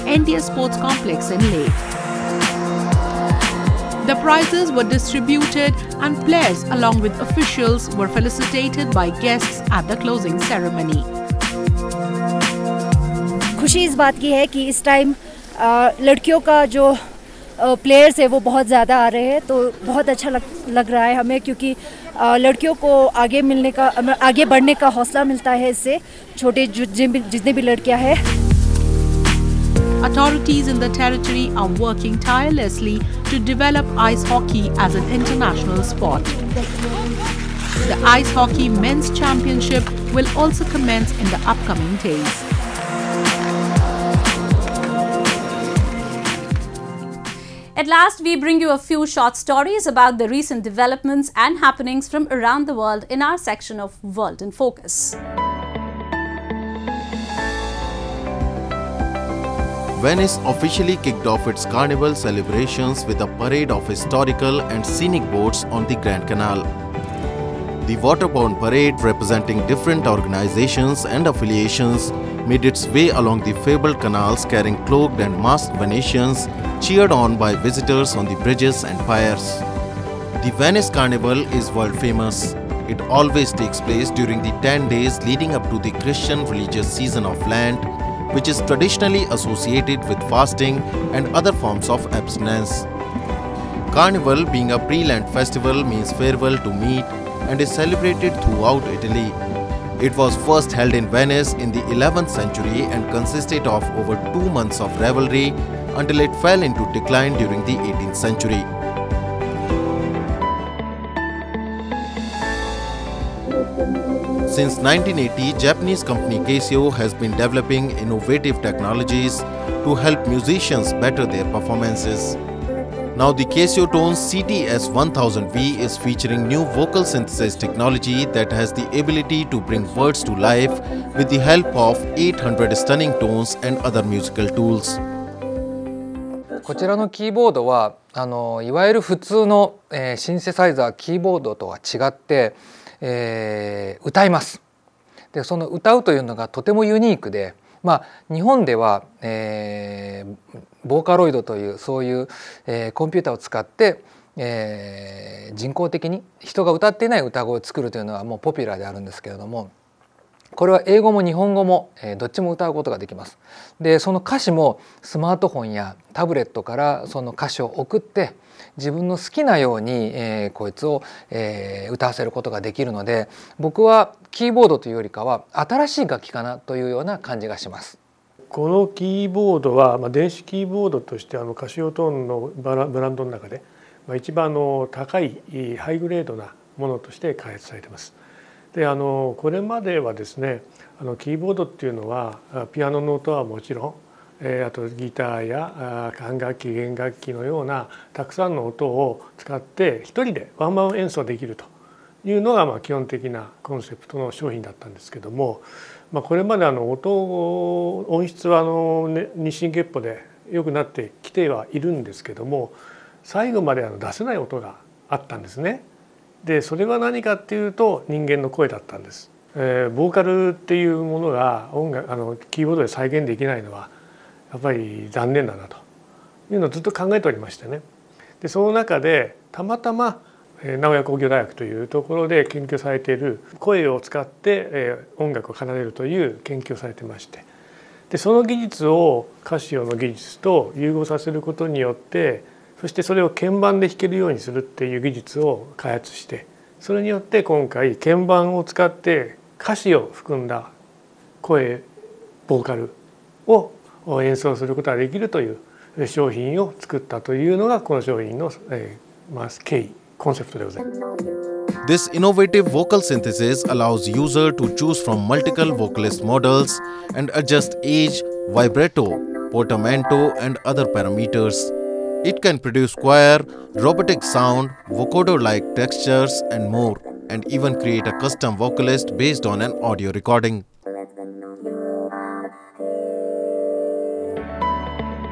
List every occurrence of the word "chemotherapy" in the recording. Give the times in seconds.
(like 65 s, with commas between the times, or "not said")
not said.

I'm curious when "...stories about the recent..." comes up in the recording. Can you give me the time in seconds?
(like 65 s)
49 s.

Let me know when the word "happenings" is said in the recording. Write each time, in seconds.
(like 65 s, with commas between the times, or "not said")
51 s.